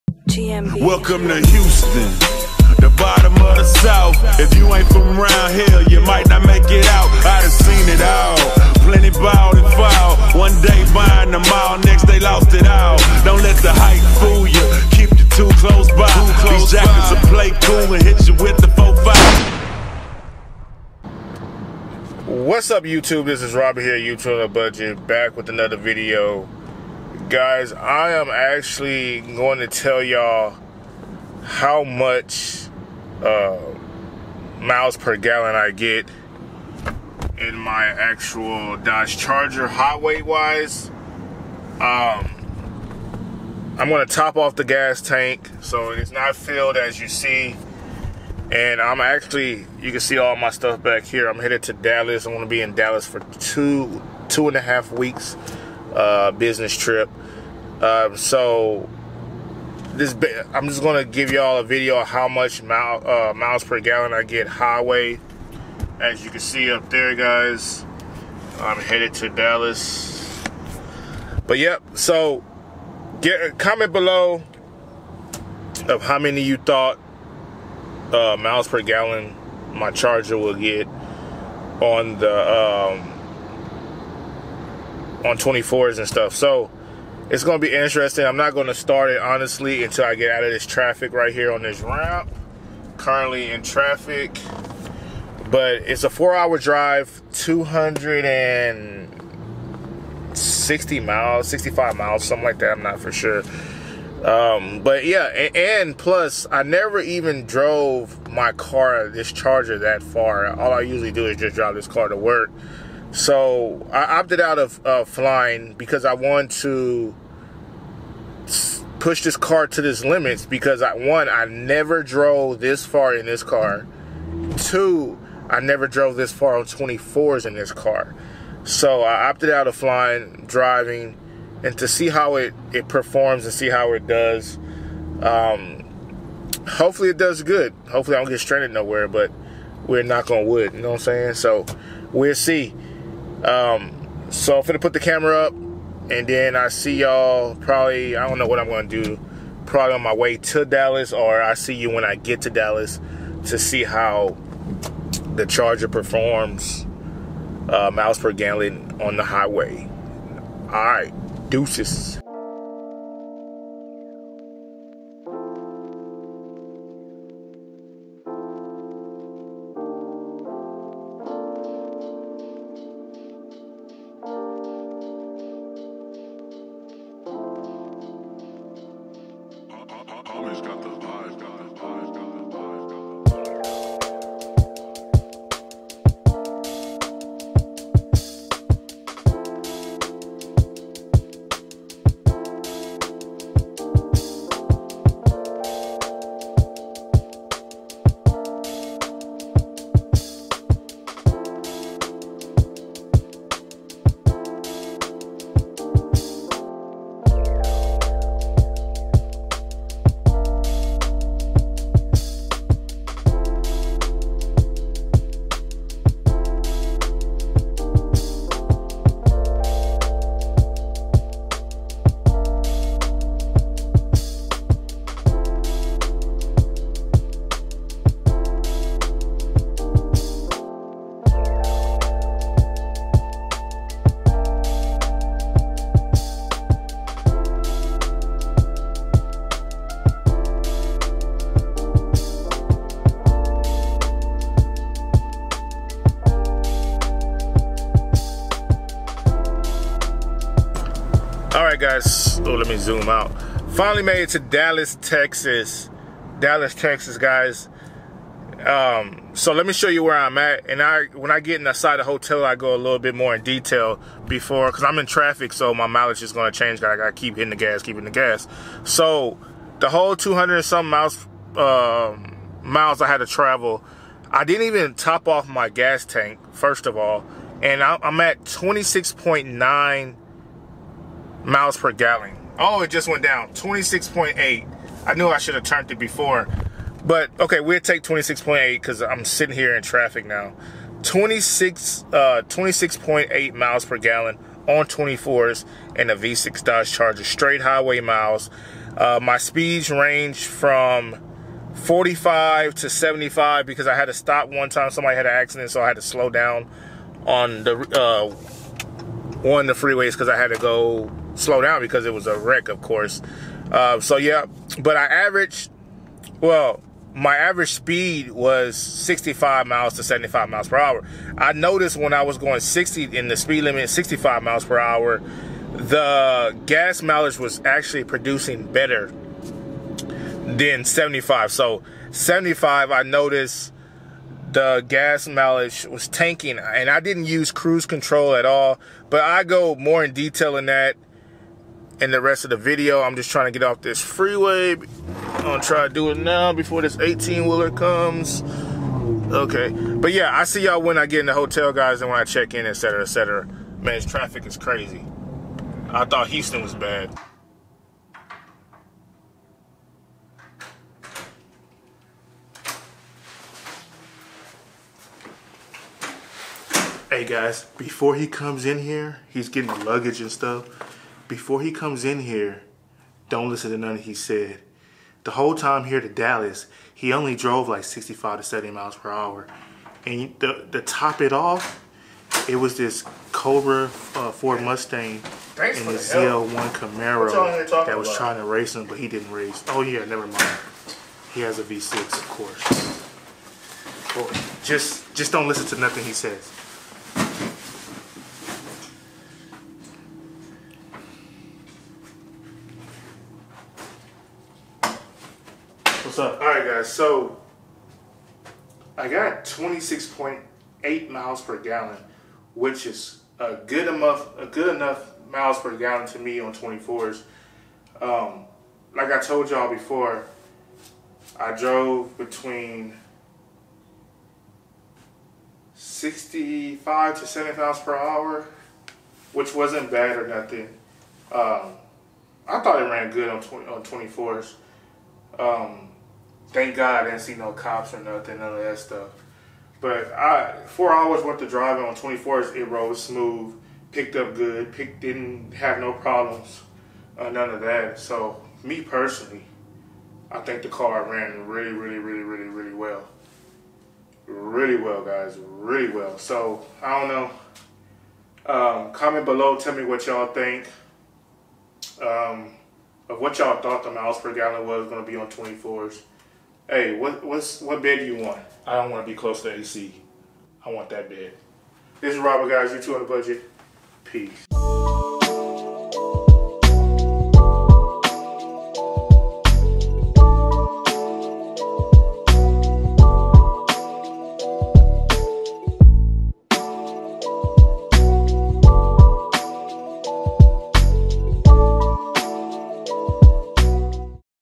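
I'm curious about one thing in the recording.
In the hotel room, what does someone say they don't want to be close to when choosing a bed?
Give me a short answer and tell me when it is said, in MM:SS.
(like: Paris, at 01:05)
AC, at 07:49.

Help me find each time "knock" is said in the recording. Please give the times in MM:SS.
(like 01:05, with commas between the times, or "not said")
02:20.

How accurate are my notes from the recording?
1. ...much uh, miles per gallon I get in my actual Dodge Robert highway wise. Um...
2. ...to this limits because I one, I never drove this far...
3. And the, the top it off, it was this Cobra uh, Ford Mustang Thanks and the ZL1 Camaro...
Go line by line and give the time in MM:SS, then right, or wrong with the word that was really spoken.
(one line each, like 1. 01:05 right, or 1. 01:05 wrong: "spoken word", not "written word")
1. 00:31 wrong: "Charger", not "Robert"
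2. 01:59 right
3. 06:20 right.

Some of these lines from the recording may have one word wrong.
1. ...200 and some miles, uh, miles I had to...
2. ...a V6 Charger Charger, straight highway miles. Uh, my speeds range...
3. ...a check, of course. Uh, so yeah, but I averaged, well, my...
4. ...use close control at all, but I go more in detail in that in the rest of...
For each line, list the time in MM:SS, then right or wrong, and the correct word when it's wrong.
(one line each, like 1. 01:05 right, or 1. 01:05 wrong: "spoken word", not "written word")
1. 04:30 right
2. 04:56 wrong: "Dodge", not "Charger"
3. 05:12 wrong: "wreck", not "check"
4. 05:37 wrong: "cruise", not "close".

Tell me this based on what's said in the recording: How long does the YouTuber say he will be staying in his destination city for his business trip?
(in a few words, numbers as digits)
2 and a half weeks.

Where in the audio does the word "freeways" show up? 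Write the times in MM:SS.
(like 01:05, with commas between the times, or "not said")
05:09, 05:44.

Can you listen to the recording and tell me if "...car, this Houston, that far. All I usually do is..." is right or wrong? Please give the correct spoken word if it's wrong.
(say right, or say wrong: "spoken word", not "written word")
wrong: "Charger", not "Houston".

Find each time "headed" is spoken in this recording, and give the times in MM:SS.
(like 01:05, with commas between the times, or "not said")
00:51, 01:08.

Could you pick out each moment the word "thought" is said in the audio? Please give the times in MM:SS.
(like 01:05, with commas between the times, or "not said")
01:16, 05:56, 07:12, 07:43.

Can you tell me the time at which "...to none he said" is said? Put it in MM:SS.
06:13.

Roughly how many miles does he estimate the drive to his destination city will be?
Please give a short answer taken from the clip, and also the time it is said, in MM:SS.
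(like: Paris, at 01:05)
260 miles, at 01:37.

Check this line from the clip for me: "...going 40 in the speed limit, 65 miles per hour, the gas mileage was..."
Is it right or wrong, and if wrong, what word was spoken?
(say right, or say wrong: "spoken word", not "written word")
wrong: "60", not "40".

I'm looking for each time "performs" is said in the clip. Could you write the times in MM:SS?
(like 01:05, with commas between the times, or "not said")
02:12, 02:35.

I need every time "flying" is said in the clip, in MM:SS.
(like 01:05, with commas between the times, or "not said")
01:55, 02:09.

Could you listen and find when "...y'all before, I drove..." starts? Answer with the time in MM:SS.
06:59.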